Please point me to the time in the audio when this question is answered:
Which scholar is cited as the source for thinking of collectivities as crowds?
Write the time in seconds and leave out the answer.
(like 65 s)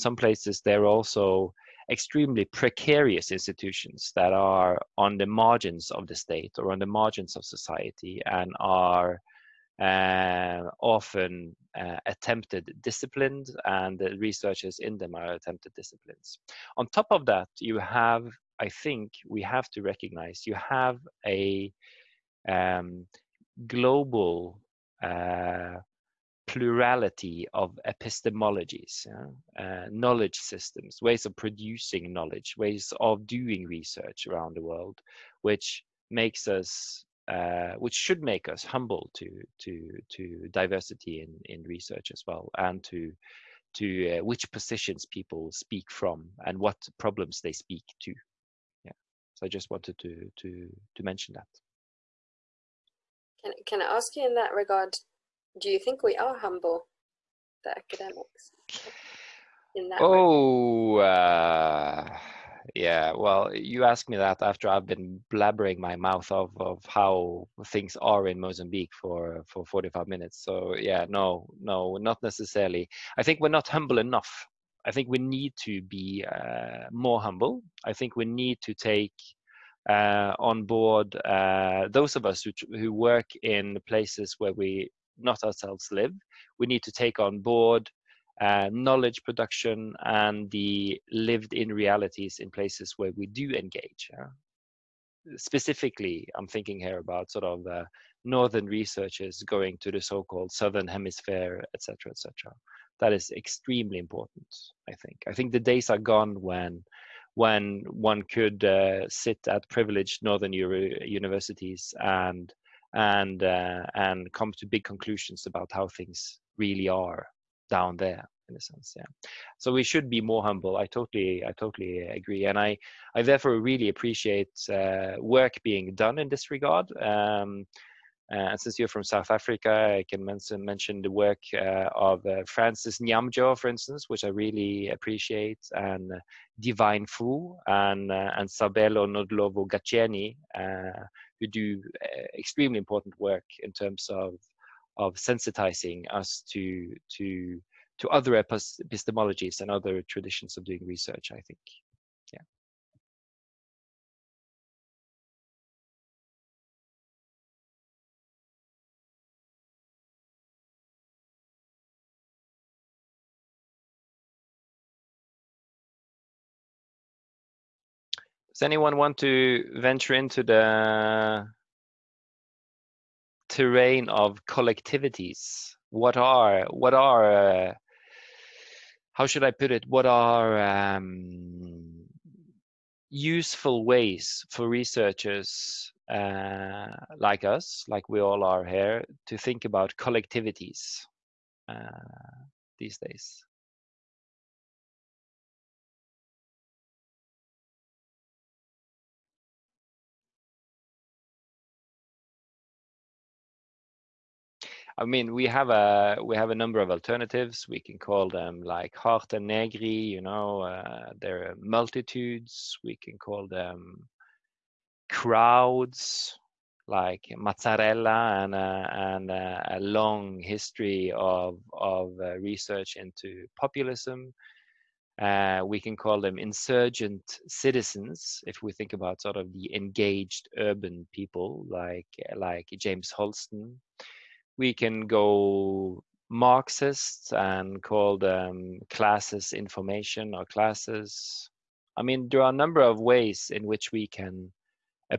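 217 s.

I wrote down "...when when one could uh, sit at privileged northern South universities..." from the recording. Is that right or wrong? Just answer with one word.
wrong.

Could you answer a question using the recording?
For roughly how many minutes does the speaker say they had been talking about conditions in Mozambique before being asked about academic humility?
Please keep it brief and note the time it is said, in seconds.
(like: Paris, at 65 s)
45, at 69 s.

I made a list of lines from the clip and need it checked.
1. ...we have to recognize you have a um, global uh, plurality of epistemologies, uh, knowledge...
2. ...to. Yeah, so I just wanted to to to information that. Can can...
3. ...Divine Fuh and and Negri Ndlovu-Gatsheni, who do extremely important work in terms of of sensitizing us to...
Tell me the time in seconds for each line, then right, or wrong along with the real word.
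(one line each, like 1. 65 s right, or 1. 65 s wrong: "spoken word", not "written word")
1. 19 s right
2. 47 s wrong: "mention", not "information"
3. 136 s wrong: "Sabelo", not "Negri".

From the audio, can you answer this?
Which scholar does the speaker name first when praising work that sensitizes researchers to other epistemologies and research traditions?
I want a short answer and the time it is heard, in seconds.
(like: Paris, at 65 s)
Francis Nyamnjoh, at 132 s.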